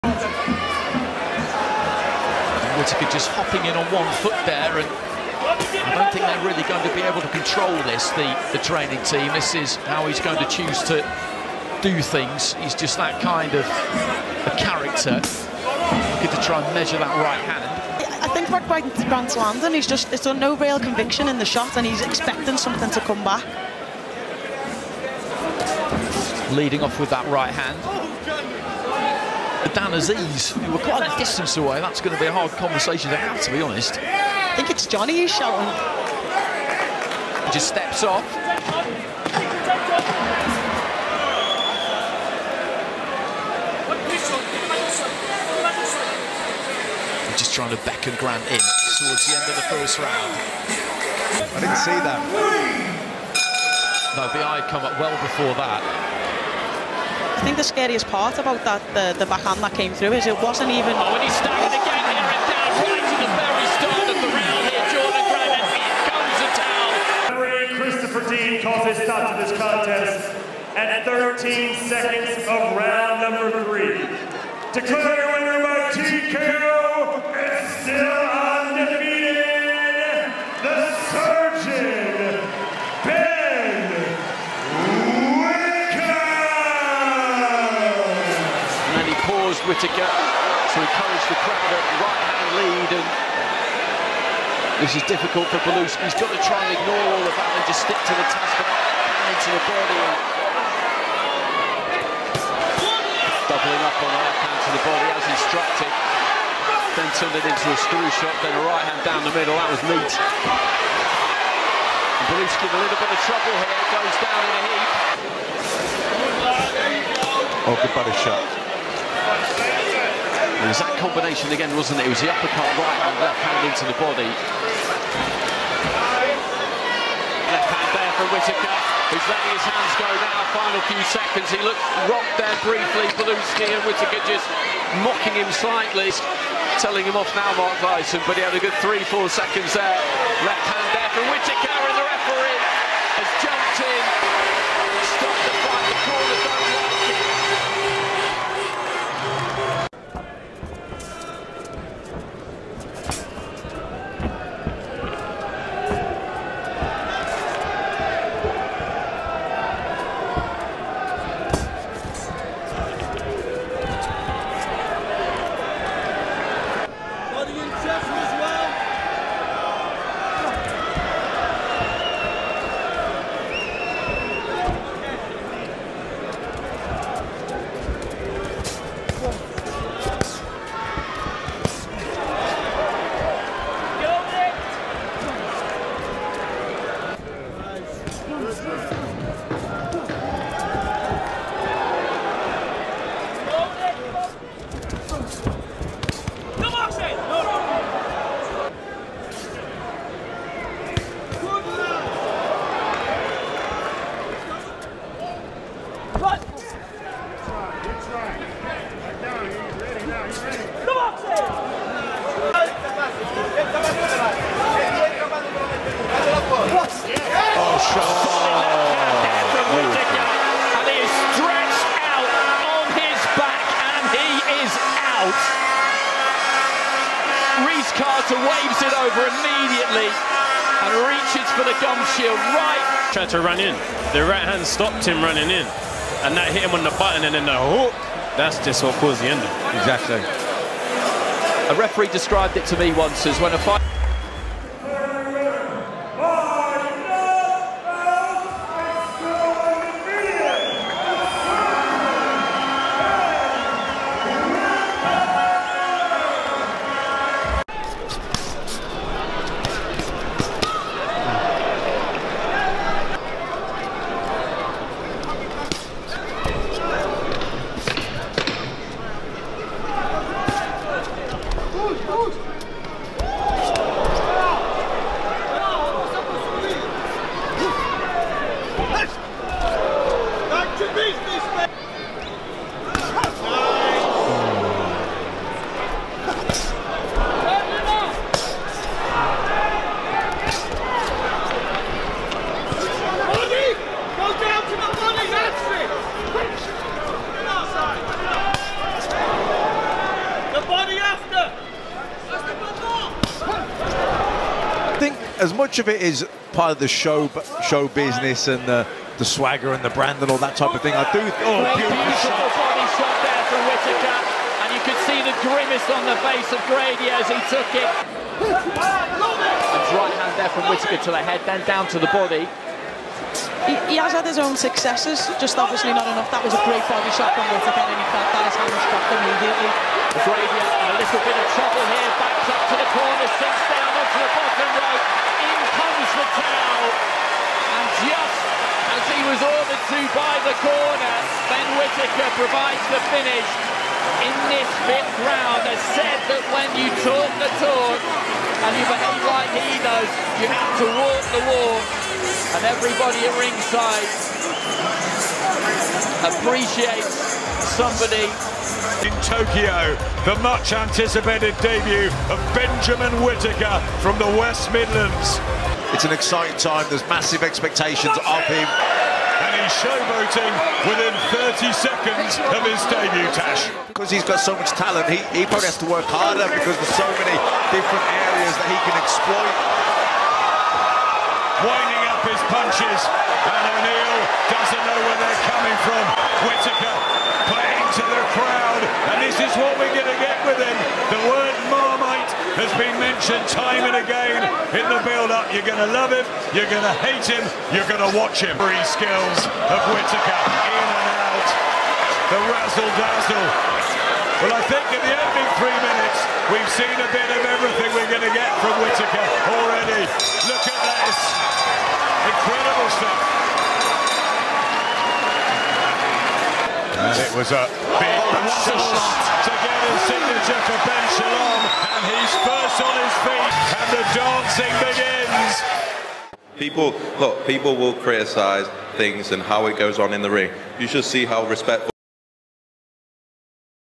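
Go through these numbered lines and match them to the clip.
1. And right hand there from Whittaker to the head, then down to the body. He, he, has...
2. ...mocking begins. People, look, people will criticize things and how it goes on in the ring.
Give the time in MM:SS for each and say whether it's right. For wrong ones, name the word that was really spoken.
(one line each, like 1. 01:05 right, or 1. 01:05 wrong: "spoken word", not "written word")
1. 05:17 right
2. 07:05 wrong: "dancing", not "mocking".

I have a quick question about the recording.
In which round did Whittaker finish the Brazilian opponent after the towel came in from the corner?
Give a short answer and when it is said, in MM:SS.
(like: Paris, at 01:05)
fifth, at 05:44.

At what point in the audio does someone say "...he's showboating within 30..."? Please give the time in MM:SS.
06:09.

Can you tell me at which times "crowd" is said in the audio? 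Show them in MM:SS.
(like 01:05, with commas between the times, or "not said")
01:31, 06:28.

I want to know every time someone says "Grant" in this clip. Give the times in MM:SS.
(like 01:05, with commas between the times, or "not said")
00:19, 00:48.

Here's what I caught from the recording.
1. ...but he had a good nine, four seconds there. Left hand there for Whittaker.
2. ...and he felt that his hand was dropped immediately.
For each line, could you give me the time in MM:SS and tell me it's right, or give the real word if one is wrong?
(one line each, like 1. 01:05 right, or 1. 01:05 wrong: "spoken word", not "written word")
1. 02:18 wrong: "three", not "nine"
2. 05:27 right.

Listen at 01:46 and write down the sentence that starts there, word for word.
Then turned it into a screw shot, then a right hand down the middle.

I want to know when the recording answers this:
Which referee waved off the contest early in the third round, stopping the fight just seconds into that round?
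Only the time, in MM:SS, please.
01:07.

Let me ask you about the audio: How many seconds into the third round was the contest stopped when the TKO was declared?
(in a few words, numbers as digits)
13.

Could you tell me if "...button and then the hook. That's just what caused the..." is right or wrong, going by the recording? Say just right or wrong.
right.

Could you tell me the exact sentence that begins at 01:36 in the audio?
He's got to try and ignore all of that and just stick to the task into the body.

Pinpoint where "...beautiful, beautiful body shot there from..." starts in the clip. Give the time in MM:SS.
05:11.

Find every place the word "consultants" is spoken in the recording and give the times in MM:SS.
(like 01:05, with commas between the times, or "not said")
not said.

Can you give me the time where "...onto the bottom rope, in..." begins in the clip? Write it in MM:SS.
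05:33.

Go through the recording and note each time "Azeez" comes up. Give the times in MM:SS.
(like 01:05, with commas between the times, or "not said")
00:29.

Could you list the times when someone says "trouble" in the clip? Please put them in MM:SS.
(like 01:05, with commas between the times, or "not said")
01:53, 05:31.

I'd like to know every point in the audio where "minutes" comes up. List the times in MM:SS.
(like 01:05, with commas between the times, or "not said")
06:45.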